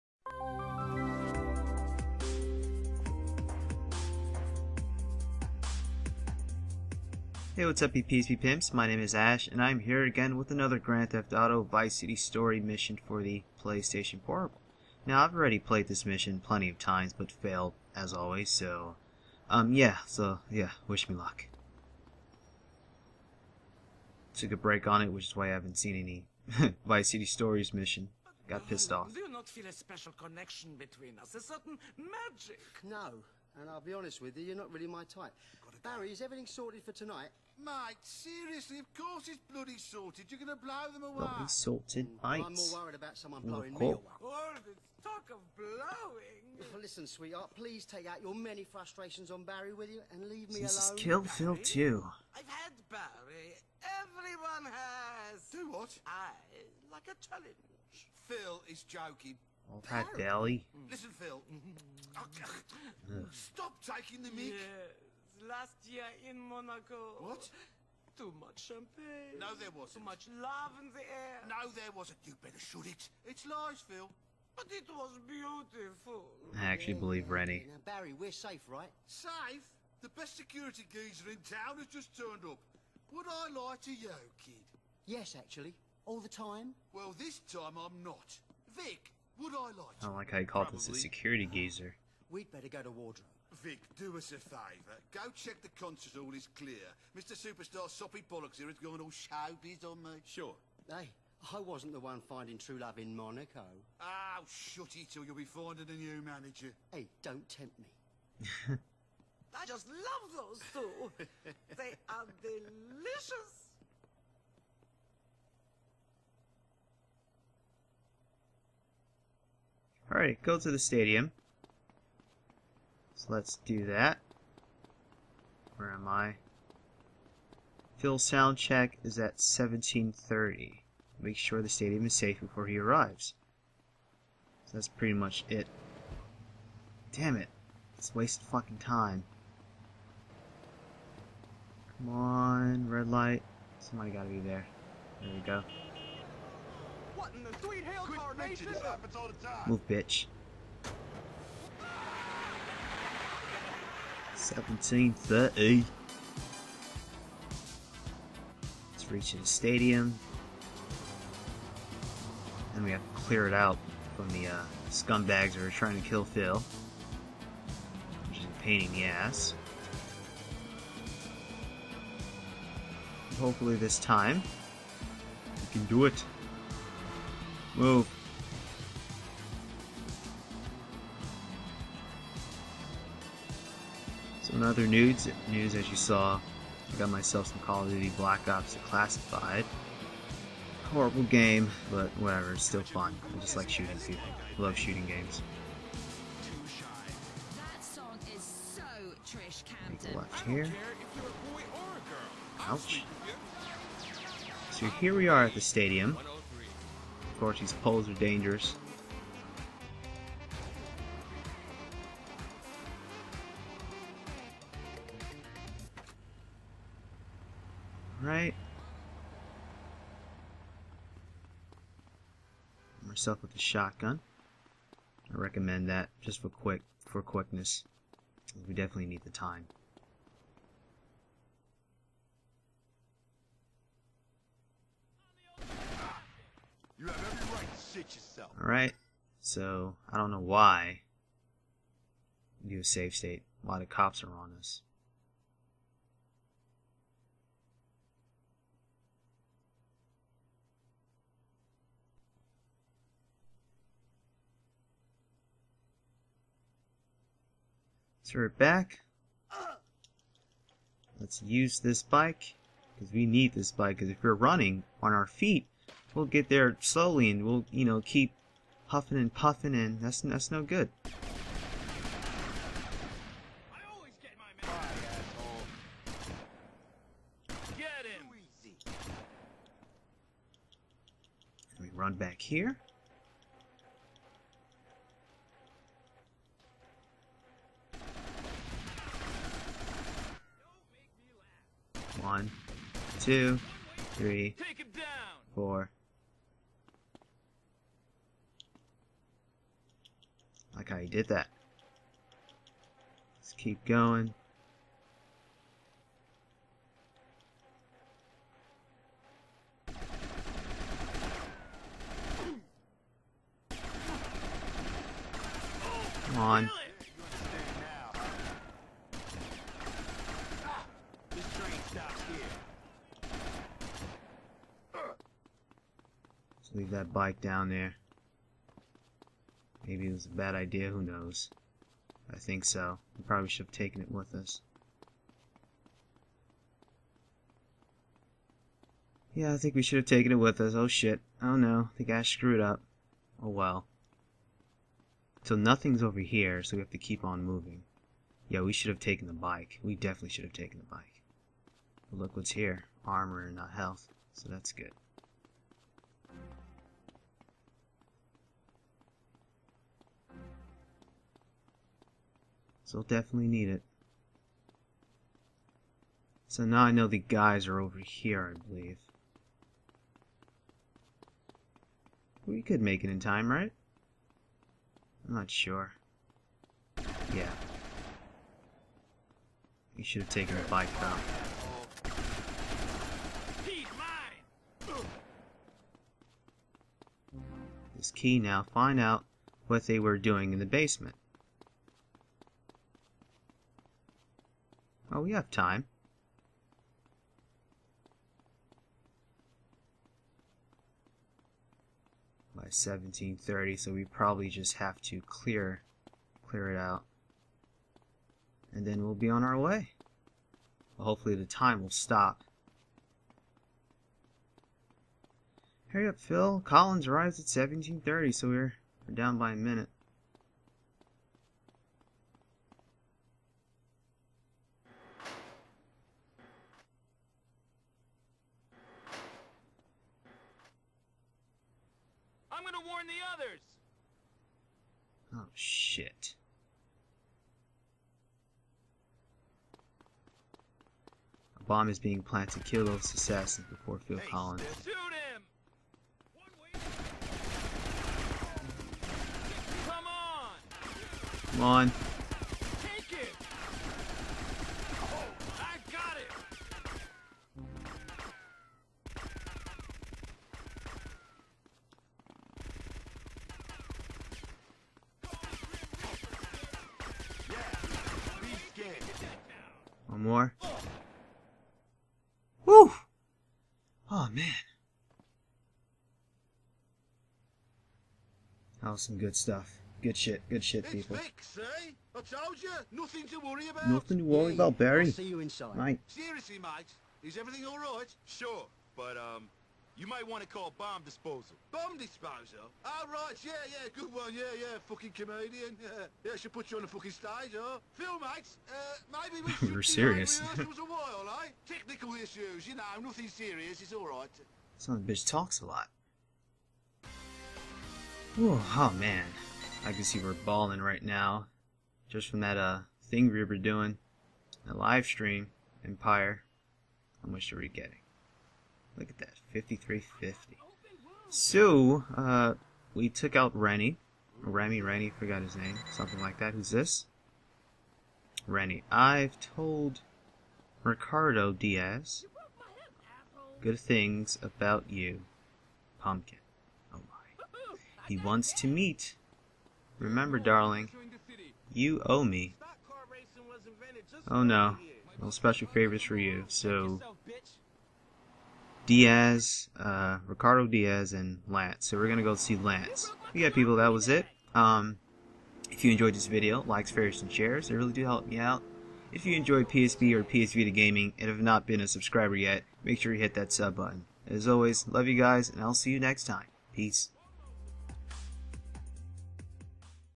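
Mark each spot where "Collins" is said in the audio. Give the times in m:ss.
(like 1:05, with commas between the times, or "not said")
6:56, 7:24.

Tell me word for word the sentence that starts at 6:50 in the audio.
Well, hopefully the time will stop.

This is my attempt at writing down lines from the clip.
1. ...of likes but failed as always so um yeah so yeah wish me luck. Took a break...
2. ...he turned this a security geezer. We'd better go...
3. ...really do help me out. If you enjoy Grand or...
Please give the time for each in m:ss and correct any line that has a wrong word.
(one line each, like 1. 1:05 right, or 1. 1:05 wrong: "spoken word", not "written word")
1. 0:16 wrong: "times", not "likes"
2. 1:30 wrong: "called", not "turned"
3. 9:17 wrong: "PSP", not "Grand".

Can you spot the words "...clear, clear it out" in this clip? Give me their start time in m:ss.
6:45.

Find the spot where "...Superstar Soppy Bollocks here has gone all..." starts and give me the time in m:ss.
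1:37.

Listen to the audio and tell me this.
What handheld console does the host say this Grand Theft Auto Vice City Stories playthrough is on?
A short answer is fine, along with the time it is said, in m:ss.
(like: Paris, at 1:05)
PlayStation Portable, at 0:13.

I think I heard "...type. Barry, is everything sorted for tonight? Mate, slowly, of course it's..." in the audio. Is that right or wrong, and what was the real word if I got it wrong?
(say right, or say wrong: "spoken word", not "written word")
wrong: "seriously", not "slowly".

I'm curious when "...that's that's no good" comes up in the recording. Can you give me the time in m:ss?
4:30.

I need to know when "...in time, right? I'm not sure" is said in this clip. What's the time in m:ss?
6:13.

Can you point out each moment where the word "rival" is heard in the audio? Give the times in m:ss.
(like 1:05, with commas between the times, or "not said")
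not said.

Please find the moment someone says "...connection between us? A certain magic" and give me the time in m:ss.
0:30.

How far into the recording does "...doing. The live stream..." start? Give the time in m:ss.
8:33.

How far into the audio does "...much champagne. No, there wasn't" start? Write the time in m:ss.
1:08.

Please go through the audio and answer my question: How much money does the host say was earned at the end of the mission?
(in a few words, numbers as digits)
5350.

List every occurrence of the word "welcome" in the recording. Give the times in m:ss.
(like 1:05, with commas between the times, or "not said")
not said.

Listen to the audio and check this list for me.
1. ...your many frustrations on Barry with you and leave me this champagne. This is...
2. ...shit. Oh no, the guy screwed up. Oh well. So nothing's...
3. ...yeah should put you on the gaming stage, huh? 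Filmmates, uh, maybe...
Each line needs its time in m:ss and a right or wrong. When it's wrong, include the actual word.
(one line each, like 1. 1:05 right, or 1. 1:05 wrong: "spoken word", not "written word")
1. 0:48 wrong: "alone", not "champagne"
2. 5:40 right
3. 8:16 wrong: "fucking", not "gaming".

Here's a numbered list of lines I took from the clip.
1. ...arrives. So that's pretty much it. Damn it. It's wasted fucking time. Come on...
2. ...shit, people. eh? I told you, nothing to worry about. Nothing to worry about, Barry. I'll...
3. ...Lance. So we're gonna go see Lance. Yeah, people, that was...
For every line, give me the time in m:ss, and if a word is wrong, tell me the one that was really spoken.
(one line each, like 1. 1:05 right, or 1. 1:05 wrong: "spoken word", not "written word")
1. 2:12 right
2. 8:00 right
3. 9:11 right.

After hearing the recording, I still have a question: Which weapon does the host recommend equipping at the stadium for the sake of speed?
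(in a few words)
Shotgun.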